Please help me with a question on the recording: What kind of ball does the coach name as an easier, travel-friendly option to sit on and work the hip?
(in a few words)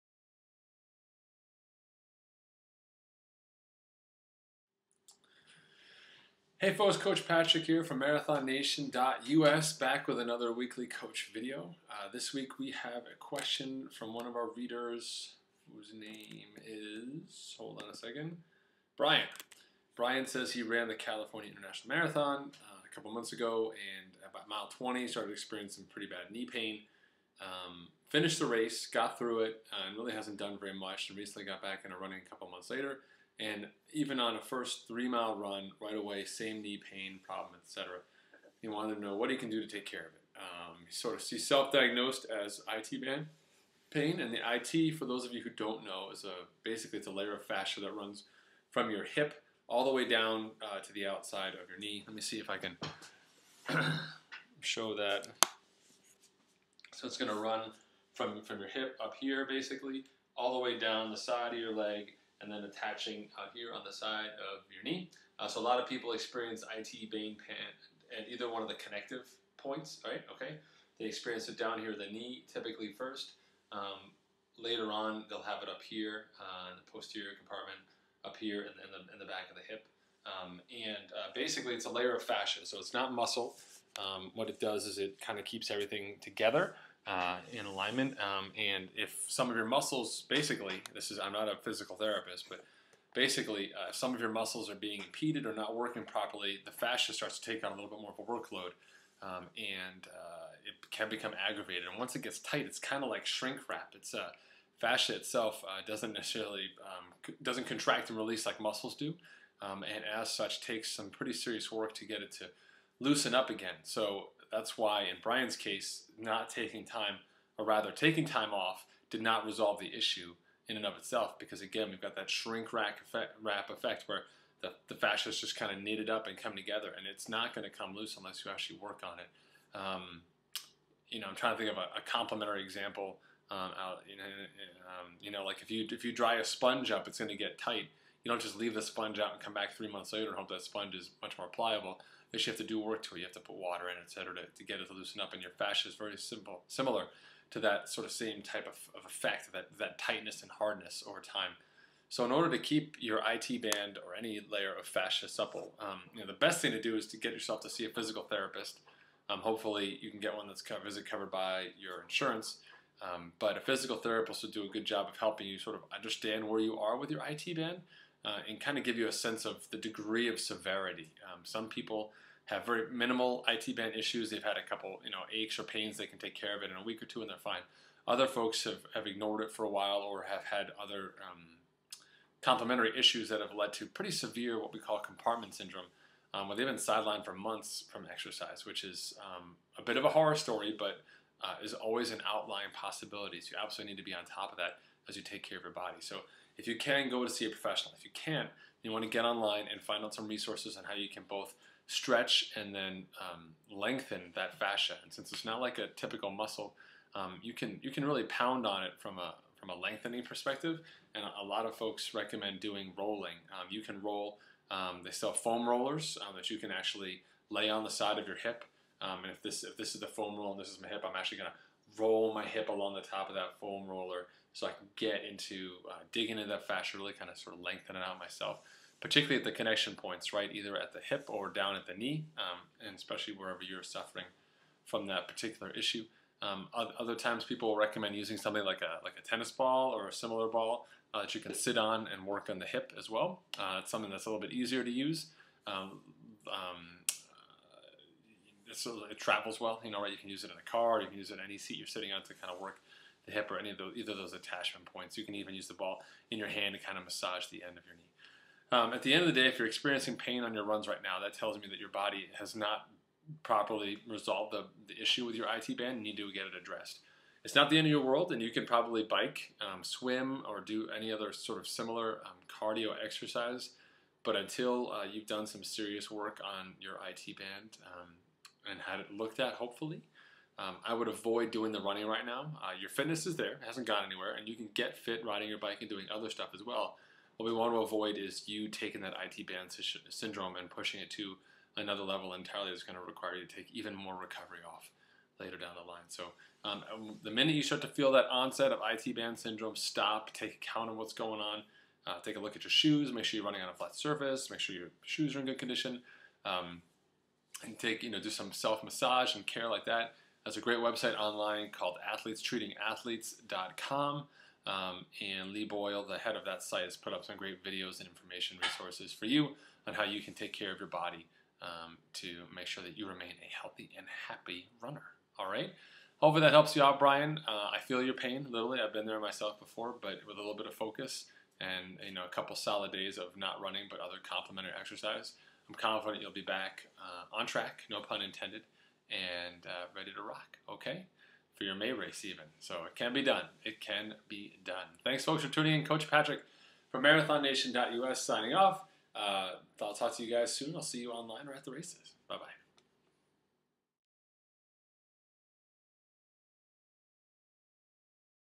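tennis ball.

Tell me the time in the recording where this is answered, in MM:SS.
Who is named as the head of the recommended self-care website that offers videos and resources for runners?
05:15.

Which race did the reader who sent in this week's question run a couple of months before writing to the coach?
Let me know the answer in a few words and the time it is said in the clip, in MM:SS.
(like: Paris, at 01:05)
California International Marathon, at 00:20.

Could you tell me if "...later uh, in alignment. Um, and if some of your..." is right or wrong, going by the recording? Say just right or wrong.
wrong.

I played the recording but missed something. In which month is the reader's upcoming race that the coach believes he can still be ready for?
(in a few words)
May.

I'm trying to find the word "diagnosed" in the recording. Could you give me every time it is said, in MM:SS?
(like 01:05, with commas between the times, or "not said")
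00:41.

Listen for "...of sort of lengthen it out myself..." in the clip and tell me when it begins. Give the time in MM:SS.
03:47.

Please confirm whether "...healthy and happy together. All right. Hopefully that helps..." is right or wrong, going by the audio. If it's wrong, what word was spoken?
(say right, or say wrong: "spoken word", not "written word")
wrong: "runner", not "together".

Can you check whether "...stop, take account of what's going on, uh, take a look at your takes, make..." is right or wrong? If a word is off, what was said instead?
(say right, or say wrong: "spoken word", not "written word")
wrong: "shoes", not "takes".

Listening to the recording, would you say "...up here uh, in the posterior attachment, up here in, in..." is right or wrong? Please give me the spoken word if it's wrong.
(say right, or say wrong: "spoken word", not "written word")
wrong: "compartment", not "attachment".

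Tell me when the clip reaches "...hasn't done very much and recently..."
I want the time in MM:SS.
00:30.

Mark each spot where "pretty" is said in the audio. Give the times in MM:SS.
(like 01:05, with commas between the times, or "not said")
00:25, 01:51, 03:03.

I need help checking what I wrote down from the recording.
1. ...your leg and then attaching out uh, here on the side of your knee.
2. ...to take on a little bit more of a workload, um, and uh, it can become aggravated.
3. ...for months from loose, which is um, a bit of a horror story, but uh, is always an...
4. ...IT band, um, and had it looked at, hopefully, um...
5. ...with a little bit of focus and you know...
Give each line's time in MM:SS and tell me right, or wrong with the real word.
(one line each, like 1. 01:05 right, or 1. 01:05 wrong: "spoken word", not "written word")
1. 01:01 right
2. 01:37 right
3. 03:07 wrong: "exercise", not "loose"
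4. 04:37 right
5. 05:30 right.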